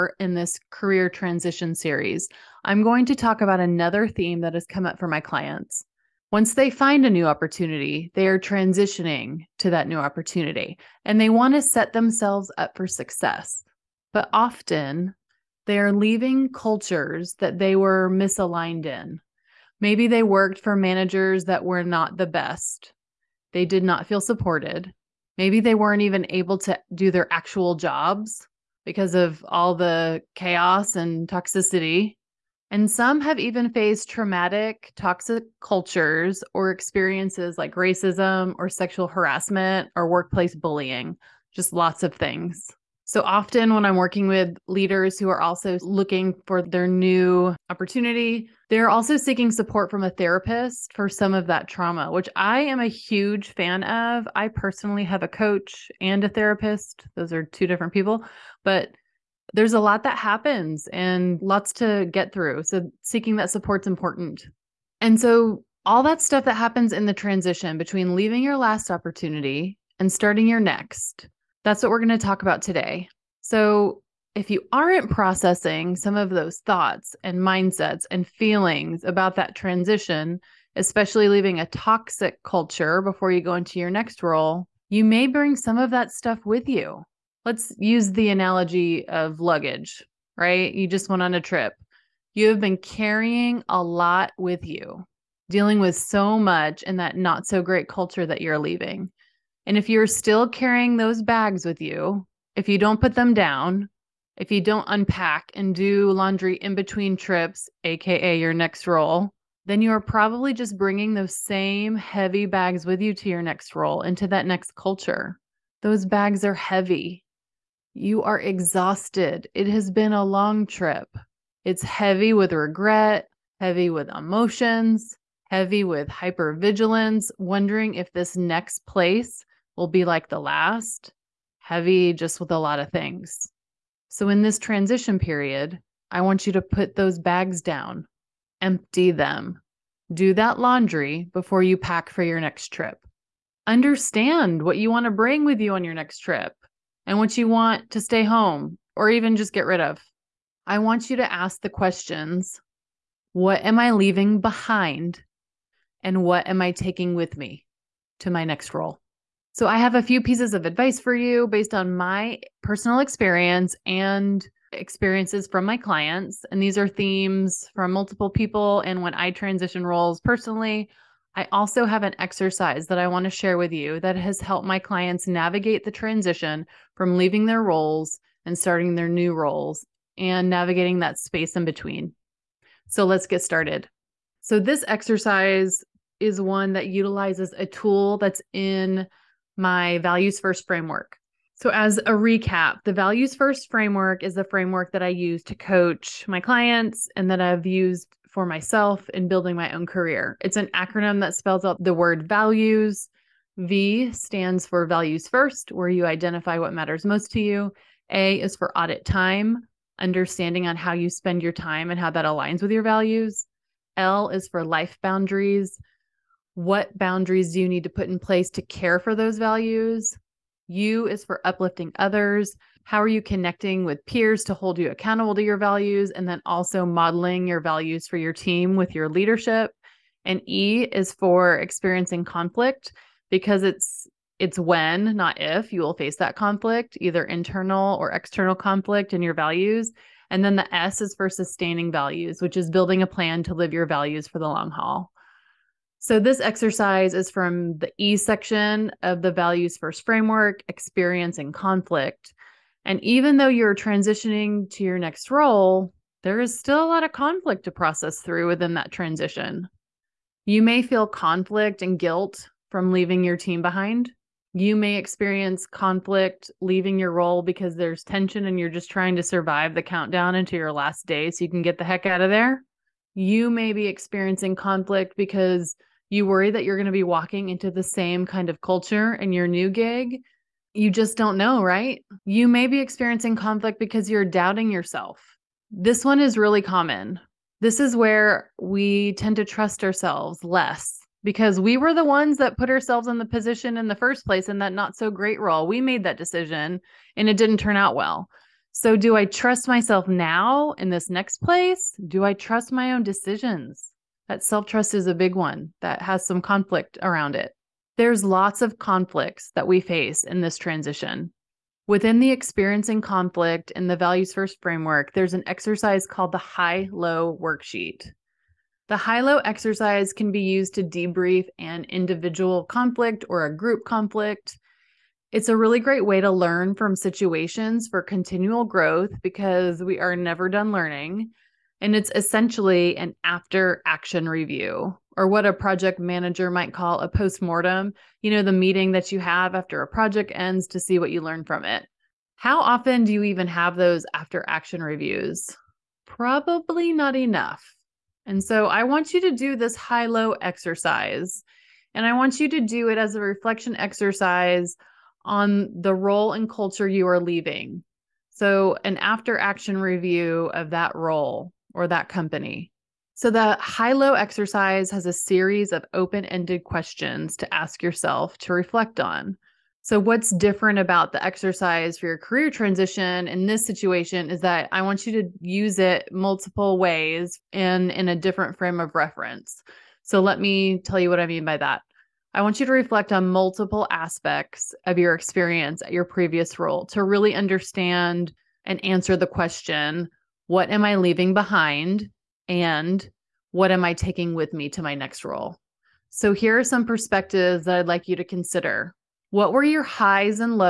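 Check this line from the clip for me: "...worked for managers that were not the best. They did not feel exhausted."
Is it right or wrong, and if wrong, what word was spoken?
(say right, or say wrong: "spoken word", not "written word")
wrong: "supported", not "exhausted".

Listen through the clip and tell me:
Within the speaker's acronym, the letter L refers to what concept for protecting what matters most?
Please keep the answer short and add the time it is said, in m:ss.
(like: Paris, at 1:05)
Life boundaries, at 3:34.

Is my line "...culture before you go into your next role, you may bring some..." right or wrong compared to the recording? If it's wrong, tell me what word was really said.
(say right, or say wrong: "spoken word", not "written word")
right.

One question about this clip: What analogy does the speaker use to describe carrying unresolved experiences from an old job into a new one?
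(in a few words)
Luggage.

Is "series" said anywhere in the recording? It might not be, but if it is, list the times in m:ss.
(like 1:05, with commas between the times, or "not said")
0:01, 6:05.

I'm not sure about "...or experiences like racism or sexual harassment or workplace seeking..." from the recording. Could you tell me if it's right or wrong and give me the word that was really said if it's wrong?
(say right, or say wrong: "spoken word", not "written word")
wrong: "bullying", not "seeking".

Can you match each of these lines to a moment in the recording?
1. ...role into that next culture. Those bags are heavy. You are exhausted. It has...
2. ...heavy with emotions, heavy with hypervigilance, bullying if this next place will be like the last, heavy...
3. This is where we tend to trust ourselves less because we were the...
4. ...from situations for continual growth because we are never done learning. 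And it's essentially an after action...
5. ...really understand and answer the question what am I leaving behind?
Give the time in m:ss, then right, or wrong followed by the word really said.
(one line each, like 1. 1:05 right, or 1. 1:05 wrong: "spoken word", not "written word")
1. 1:53 right
2. 2:03 wrong: "wondering", not "bullying"
3. 4:47 right
4. 5:26 right
5. 6:27 right.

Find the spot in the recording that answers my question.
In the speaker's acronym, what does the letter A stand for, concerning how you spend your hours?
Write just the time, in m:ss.
3:28.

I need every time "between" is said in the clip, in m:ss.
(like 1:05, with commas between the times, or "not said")
1:07, 1:46, 3:01.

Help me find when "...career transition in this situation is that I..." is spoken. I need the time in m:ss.
6:12.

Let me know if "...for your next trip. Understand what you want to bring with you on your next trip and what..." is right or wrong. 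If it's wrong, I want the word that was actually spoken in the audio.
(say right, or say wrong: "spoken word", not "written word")
right.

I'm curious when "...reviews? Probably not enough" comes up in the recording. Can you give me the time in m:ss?
5:44.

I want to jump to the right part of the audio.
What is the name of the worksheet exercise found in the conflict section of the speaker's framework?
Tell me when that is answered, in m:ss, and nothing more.
5:16.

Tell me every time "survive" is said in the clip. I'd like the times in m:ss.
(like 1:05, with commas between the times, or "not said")
4:29.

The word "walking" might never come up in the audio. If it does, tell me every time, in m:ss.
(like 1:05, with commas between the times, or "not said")
4:37.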